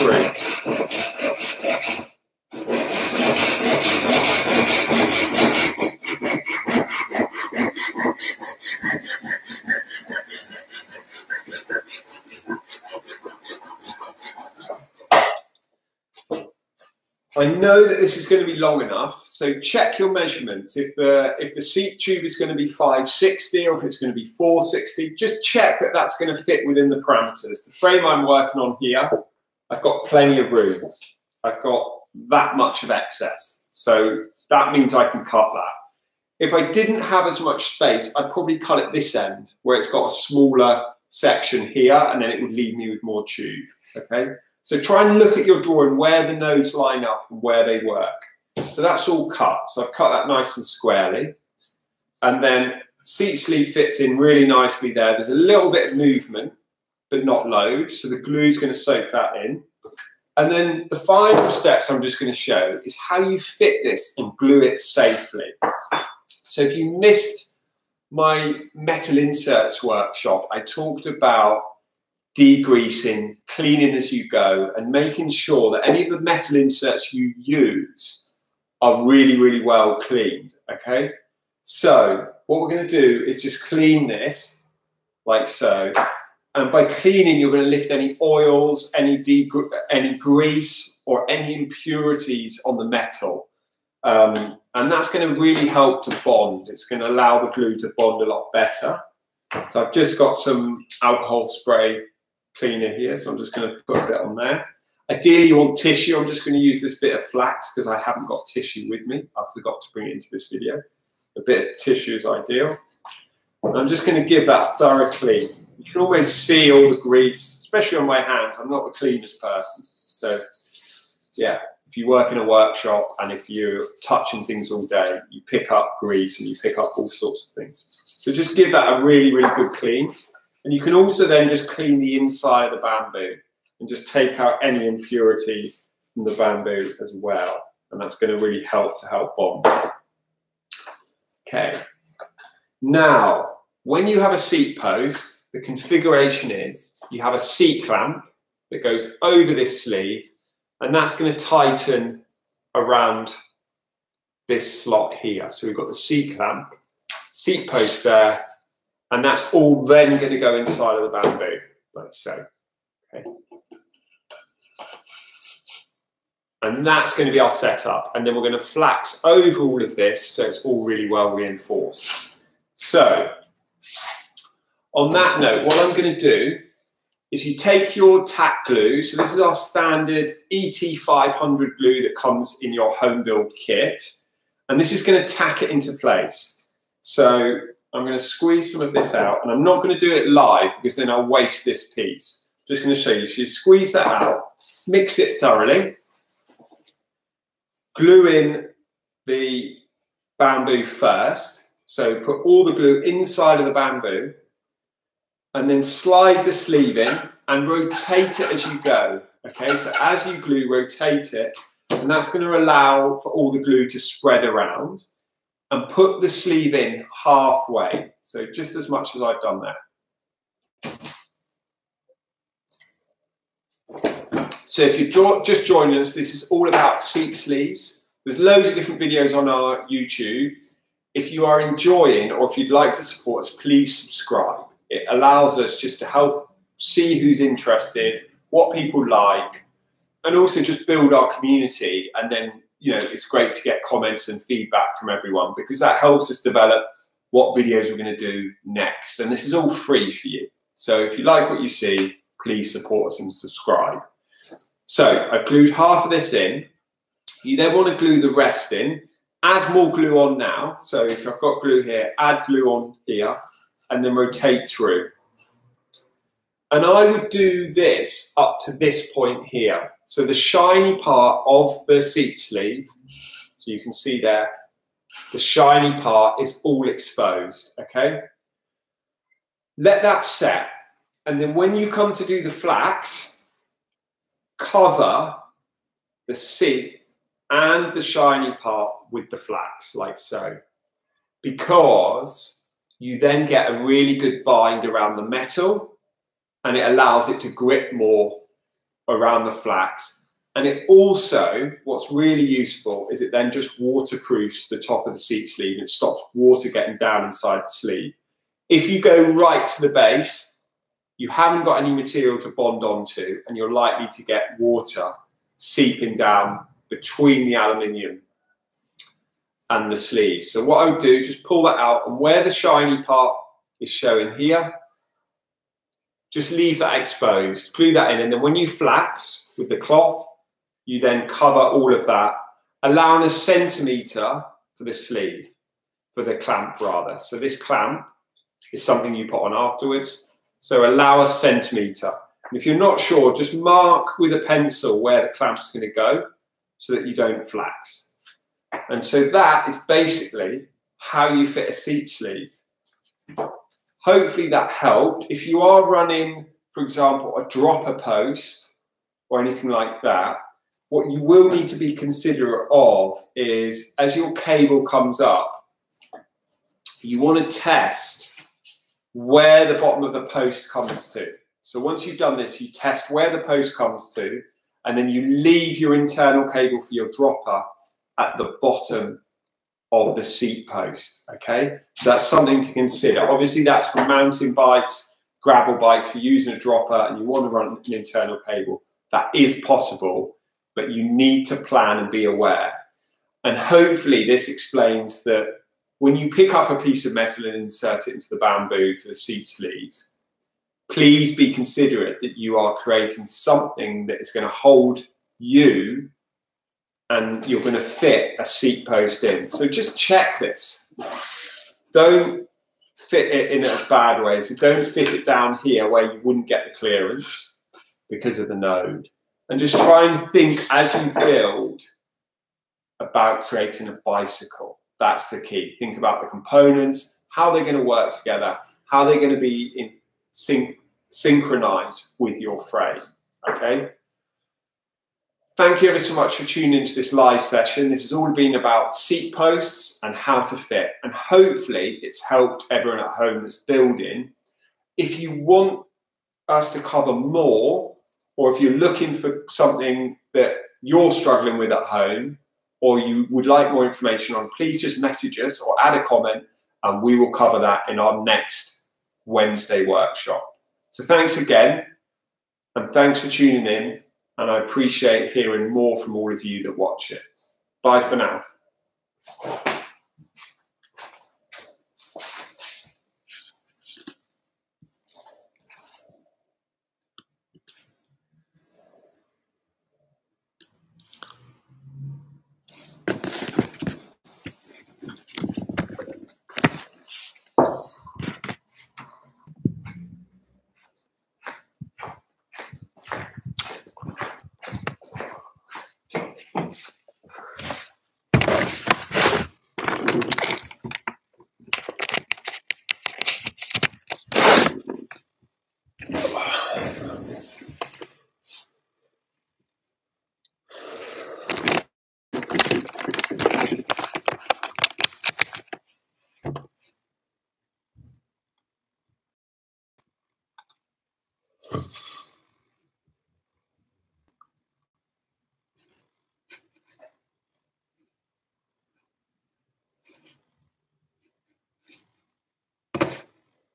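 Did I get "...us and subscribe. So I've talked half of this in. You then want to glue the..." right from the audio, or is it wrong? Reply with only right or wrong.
wrong.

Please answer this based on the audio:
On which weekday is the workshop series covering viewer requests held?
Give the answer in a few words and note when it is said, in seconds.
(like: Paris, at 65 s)
Wednesday, at 459 s.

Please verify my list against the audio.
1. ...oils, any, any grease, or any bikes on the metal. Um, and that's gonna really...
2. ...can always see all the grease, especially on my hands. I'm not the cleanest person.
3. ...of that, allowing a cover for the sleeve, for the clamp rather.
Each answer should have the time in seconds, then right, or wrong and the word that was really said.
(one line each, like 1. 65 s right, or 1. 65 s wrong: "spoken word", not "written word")
1. 88 s wrong: "impurities", not "bikes"
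2. 115 s right
3. 331 s wrong: "centimeter", not "cover".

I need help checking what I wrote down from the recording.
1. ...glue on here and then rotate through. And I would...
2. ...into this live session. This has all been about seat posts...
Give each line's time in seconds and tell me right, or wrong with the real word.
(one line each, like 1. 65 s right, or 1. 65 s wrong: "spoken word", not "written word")
1. 262 s right
2. 436 s right.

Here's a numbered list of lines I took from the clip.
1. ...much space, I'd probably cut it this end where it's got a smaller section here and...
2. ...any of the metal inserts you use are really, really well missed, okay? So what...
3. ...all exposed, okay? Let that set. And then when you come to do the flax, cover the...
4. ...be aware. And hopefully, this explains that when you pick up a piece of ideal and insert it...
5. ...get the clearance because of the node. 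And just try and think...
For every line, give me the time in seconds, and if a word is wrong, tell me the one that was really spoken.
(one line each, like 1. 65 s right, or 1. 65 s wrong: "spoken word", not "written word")
1. 37 s right
2. 75 s wrong: "cleaned", not "missed"
3. 276 s right
4. 392 s wrong: "metal", not "ideal"
5. 416 s right.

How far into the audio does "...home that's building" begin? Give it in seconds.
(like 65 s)
443 s.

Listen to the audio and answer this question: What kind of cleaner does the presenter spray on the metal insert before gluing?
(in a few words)
Alcohol spray cleaner.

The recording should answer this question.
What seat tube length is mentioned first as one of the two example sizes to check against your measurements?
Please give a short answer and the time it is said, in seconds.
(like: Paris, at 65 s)
560, at 22 s.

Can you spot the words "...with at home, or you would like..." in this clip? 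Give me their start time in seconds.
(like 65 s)
451 s.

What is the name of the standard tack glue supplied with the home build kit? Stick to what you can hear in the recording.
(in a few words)
ET500.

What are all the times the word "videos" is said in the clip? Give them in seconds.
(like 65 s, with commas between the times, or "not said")
110 s, 229 s, 247 s.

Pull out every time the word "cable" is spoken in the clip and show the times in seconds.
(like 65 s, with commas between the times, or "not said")
364 s, 376 s, 388 s.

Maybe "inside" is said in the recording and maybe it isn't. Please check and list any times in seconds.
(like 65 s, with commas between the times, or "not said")
132 s, 160 s, 203 s, 307 s.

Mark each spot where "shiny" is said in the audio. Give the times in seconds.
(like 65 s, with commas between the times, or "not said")
270 s, 275 s, 288 s, 322 s.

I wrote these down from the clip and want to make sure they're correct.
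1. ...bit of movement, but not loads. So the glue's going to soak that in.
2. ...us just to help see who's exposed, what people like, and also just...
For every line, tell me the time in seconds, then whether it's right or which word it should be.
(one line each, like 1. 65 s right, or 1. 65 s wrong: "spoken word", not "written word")
1. 55 s right
2. 235 s wrong: "interested", not "exposed".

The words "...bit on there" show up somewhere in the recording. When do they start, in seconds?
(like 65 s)
104 s.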